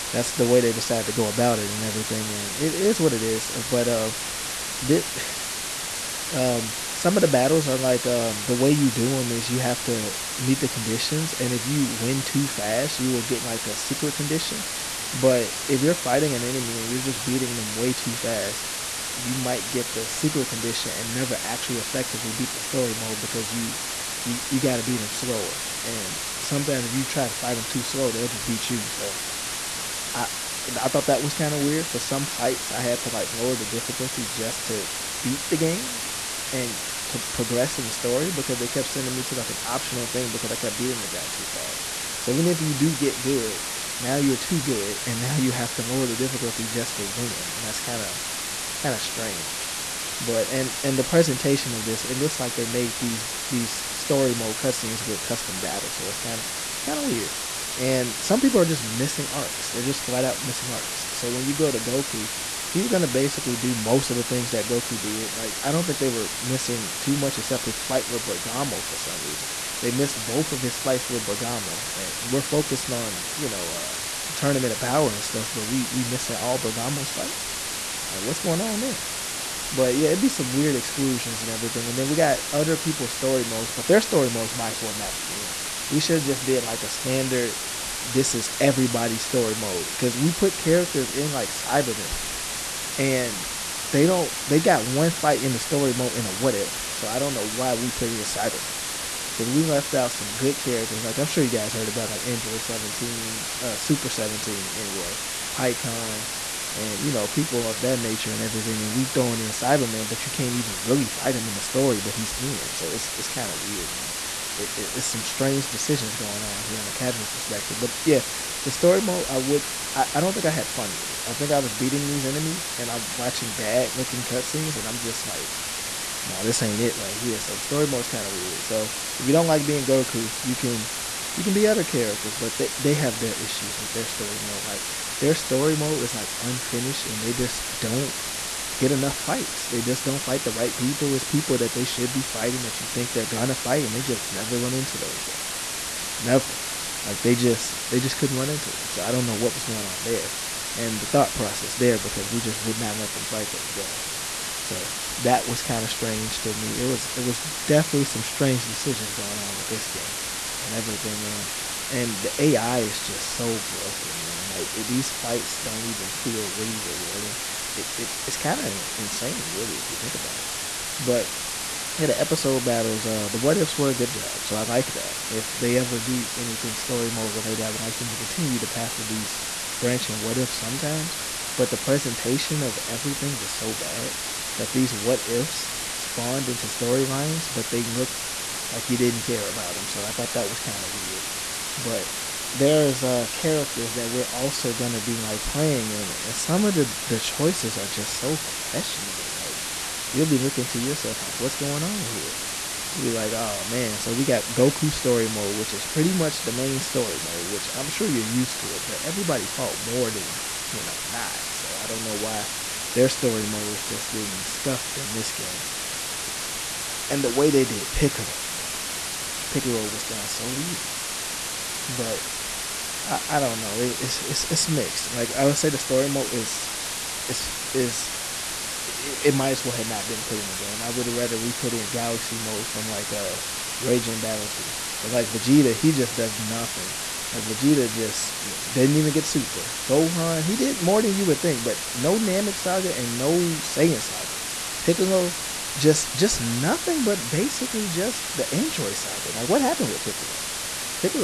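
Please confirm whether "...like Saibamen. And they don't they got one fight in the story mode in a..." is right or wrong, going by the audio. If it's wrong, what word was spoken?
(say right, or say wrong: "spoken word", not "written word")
right.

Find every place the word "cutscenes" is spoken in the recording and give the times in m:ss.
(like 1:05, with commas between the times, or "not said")
0:54, 2:04.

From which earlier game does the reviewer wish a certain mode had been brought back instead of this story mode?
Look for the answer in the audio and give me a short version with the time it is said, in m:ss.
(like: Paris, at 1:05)
Raging Blast 2, at 3:53.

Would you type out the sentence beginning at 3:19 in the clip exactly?
Like you'll be looking to yourself like, what's going on here?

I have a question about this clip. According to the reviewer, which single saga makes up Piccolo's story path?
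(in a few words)
Android saga.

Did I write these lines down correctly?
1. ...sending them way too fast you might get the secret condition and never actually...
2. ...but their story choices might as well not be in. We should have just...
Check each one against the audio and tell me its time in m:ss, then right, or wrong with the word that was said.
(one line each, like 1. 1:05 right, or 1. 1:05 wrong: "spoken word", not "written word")
1. 0:17 wrong: "beating", not "sending"
2. 1:23 wrong: "modes", not "choices".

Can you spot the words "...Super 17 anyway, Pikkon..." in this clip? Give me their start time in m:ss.
1:43.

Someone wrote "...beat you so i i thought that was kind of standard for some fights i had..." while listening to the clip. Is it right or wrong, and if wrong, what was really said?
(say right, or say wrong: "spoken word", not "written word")
wrong: "weird", not "standard".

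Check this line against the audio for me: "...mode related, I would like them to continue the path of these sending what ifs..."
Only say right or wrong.
wrong.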